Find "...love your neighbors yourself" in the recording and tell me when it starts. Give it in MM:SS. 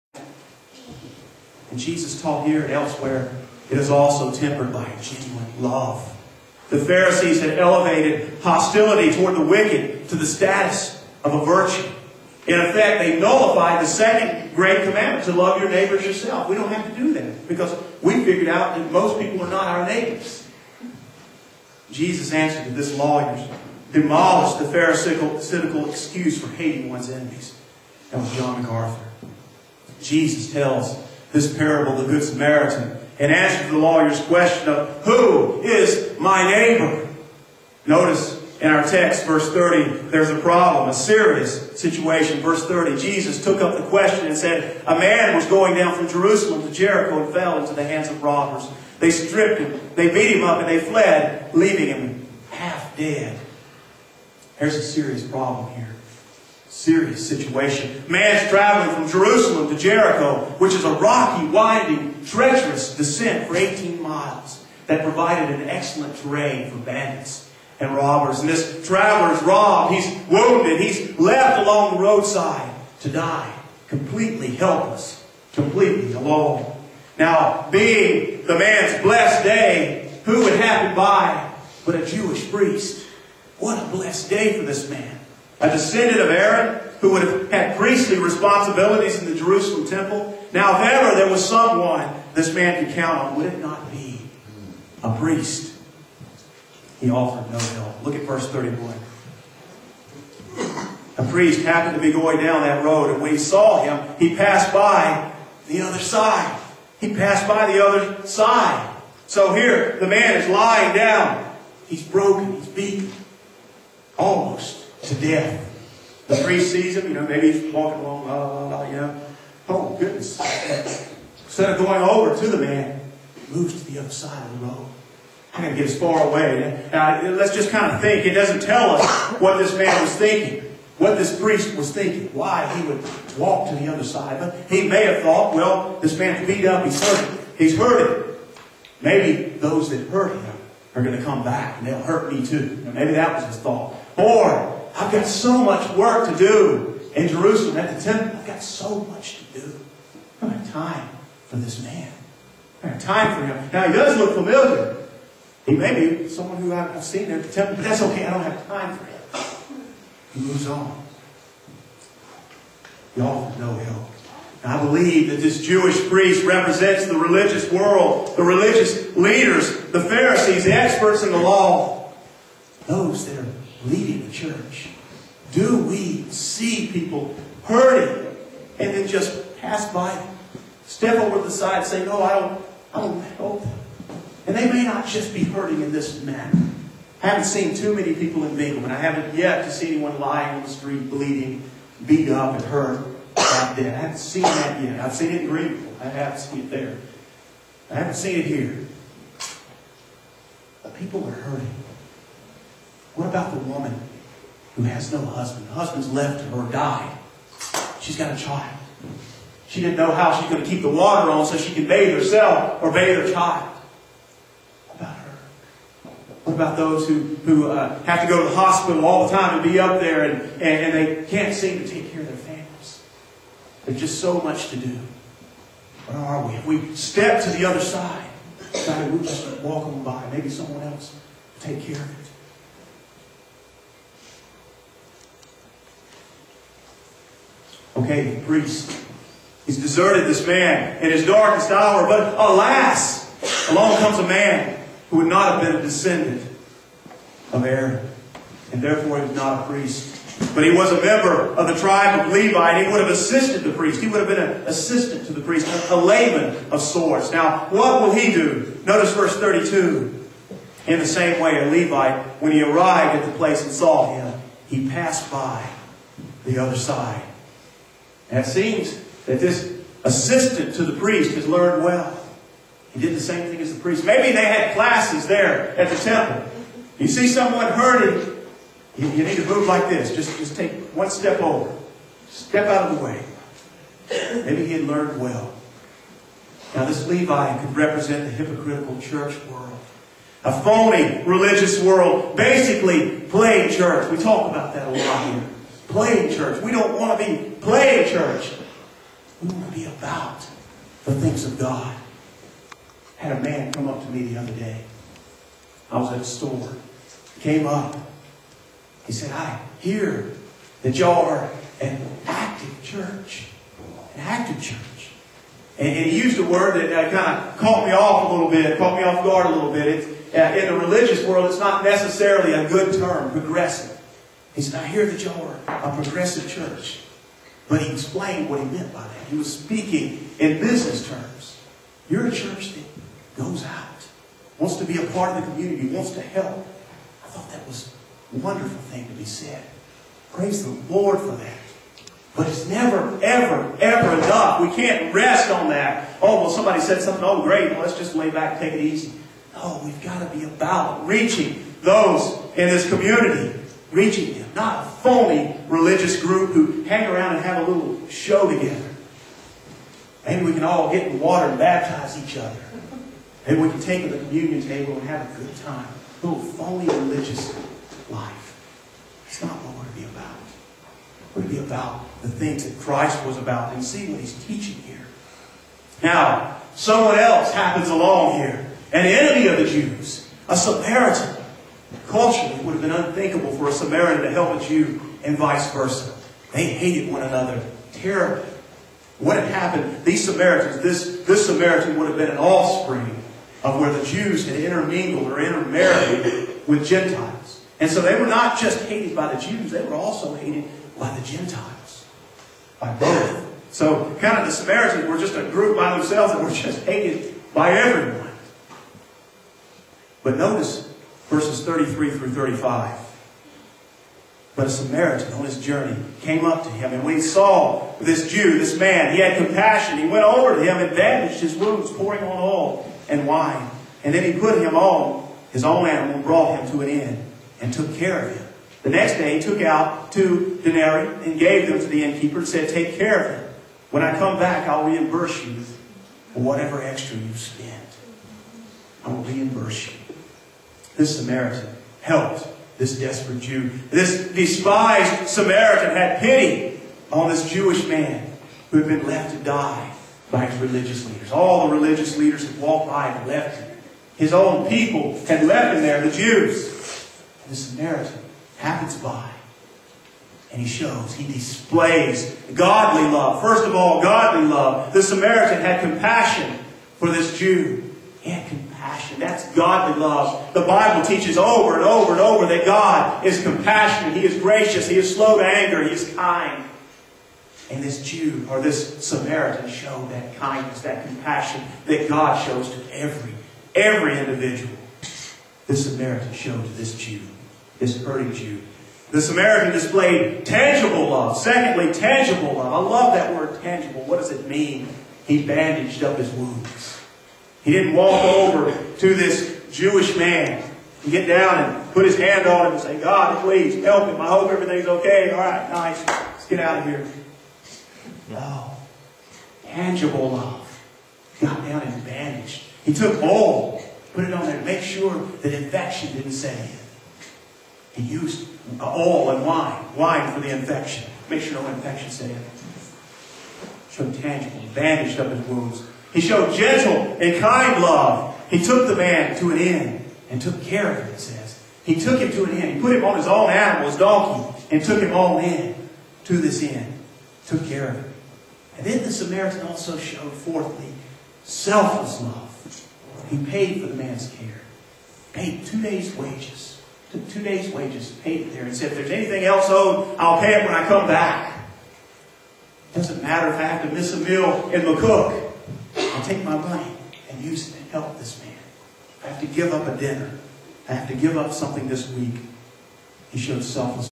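00:15.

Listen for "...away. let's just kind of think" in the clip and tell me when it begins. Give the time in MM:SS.
02:06.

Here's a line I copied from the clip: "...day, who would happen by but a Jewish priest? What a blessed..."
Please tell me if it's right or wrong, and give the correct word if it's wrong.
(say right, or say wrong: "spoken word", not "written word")
right.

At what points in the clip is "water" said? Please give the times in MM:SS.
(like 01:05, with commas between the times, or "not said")
03:30, 06:01.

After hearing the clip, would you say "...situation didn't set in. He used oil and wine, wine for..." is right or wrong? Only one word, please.
wrong.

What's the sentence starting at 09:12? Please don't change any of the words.
Doesn't matter if I have to miss a meal in cook take my money and use it to help this man.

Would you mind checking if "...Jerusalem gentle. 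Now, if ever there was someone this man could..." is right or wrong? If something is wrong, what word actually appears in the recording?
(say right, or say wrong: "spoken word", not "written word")
wrong: "temple", not "gentle".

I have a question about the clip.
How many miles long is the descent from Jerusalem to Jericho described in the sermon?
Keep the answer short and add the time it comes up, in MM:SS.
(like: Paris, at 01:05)
18, at 01:03.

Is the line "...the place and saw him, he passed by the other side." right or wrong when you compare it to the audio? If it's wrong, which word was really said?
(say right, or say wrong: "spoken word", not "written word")
right.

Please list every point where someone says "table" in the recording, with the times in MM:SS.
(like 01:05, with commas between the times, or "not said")
06:04.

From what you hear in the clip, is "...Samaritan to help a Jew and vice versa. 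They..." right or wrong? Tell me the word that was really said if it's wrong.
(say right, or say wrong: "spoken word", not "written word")
right.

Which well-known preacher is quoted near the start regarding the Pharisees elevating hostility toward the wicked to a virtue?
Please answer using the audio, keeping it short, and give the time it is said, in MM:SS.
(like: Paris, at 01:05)
John MacArthur, at 00:28.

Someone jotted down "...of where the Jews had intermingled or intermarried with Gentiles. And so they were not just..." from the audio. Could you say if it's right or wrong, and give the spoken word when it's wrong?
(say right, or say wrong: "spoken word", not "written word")
right.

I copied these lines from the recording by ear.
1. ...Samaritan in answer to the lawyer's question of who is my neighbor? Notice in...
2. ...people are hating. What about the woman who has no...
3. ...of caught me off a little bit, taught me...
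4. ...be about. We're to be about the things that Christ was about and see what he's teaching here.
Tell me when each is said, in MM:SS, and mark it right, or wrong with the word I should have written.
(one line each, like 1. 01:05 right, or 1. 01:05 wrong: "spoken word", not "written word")
1. 00:32 right
2. 03:20 wrong: "hurting", not "hating"
3. 05:17 wrong: "caught", not "taught"
4. 06:09 right.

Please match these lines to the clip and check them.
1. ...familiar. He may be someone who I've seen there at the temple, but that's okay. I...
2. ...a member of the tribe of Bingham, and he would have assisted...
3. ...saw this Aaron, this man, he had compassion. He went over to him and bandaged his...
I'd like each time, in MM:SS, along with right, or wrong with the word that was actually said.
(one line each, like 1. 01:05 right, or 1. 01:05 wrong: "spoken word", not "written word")
1. 02:34 right
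2. 04:10 wrong: "Levi", not "Bingham"
3. 06:57 wrong: "Jew", not "Aaron".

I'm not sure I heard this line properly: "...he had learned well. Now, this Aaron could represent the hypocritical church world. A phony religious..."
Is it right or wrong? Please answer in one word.
wrong.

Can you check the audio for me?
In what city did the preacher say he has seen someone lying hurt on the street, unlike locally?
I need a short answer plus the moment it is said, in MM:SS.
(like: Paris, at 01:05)
Greenville, at 03:15.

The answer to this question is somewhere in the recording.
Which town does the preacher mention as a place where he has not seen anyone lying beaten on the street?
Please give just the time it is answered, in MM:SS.
03:08.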